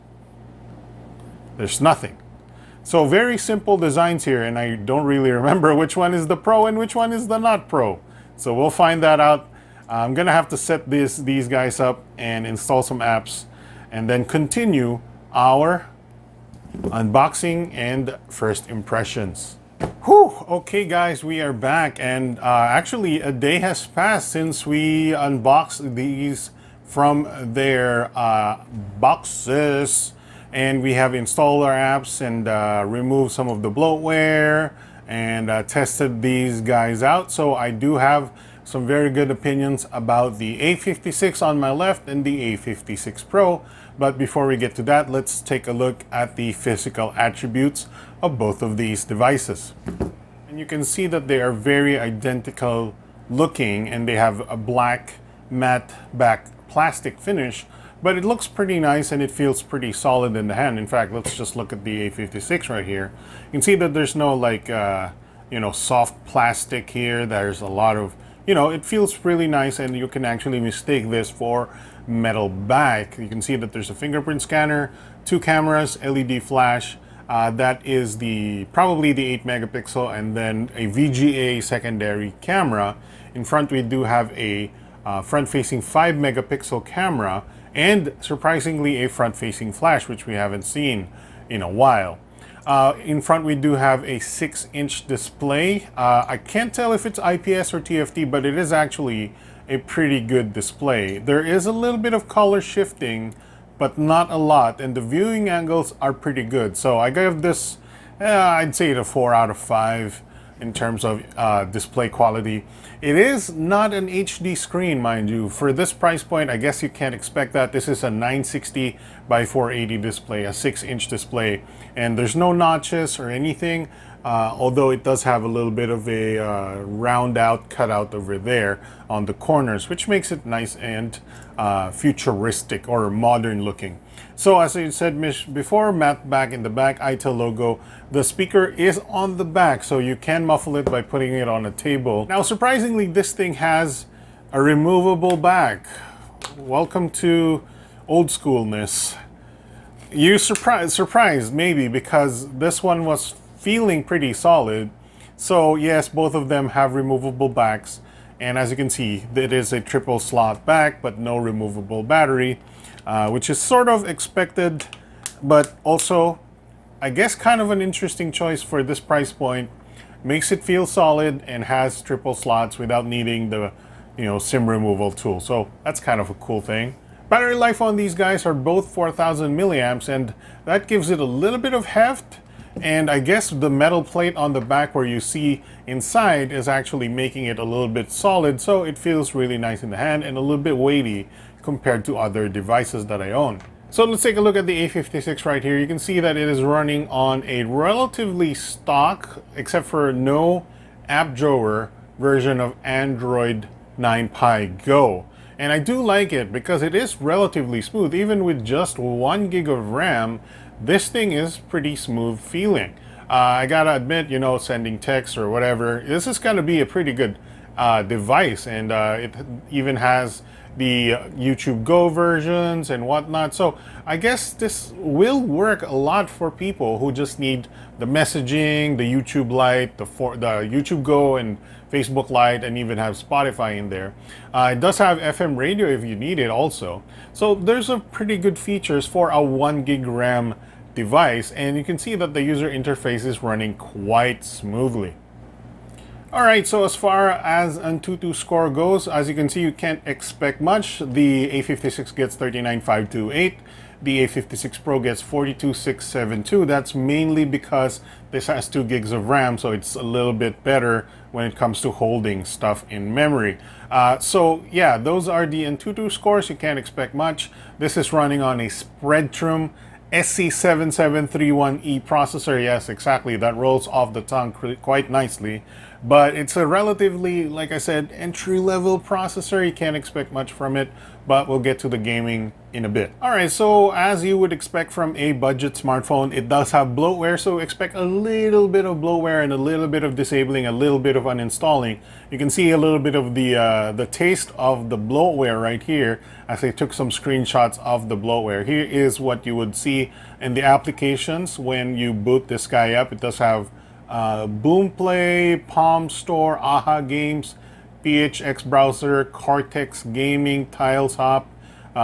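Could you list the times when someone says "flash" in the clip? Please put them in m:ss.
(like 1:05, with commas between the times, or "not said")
1:16, 1:29.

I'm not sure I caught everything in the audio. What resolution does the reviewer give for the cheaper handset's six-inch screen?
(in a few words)
960 by 480.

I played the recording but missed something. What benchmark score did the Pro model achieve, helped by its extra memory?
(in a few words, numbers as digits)
42,672.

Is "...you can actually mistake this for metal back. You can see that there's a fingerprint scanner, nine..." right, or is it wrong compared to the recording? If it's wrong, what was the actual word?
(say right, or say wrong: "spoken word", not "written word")
wrong: "two", not "nine".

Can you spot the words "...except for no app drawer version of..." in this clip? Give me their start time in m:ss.
3:19.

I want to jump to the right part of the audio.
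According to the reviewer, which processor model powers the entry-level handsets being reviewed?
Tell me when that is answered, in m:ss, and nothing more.
4:28.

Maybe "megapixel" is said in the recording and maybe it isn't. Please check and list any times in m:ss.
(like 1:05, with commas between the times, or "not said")
1:19, 1:26.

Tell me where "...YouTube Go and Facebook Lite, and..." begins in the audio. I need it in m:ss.
3:50.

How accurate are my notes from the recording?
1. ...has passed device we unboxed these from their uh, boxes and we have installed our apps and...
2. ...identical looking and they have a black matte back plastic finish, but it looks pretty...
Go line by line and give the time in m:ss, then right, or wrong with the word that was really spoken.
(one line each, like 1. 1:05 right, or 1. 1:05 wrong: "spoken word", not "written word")
1. 0:23 wrong: "since", not "device"
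2. 0:51 right.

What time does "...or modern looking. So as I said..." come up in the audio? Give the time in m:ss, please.
2:12.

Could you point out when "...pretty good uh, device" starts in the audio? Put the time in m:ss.
3:36.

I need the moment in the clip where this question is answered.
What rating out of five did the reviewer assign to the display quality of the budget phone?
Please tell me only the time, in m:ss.
1:49.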